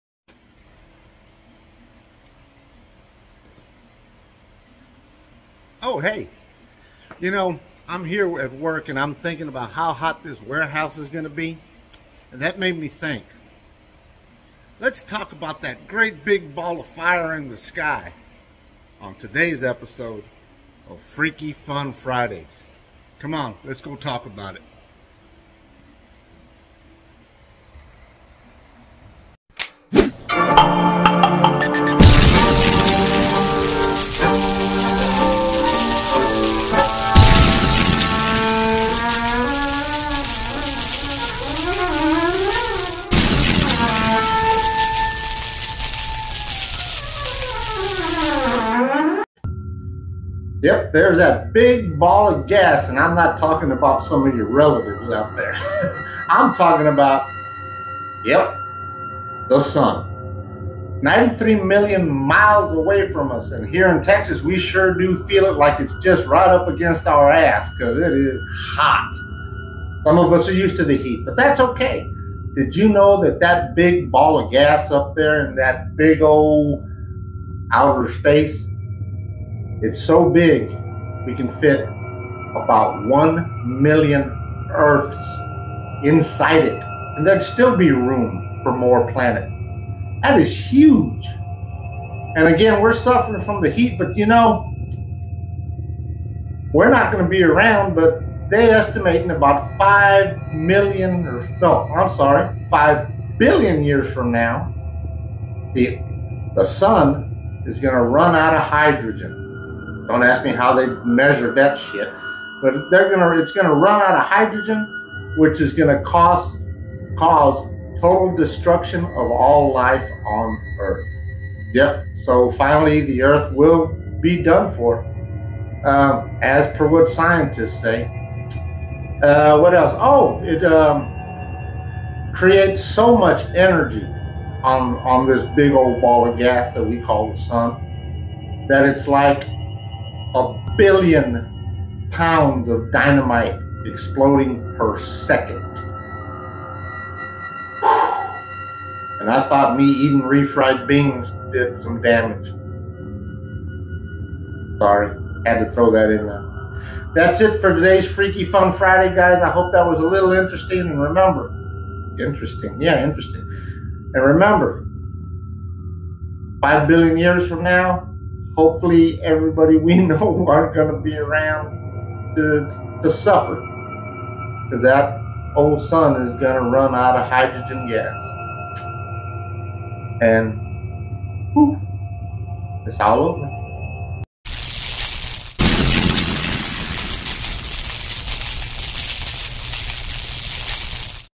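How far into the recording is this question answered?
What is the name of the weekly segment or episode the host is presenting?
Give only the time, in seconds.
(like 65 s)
21 s.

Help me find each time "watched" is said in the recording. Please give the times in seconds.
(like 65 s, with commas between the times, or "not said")
not said.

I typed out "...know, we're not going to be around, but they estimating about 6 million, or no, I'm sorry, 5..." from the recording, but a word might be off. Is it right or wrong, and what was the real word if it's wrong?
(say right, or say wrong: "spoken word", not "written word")
wrong: "5", not "6".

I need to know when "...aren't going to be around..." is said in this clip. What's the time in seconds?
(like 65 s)
170 s.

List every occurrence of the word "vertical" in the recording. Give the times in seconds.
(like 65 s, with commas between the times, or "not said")
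not said.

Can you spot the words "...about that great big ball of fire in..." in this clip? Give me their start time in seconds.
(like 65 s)
15 s.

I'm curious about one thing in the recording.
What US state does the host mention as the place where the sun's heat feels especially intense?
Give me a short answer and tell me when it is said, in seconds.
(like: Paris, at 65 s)
Texas, at 64 s.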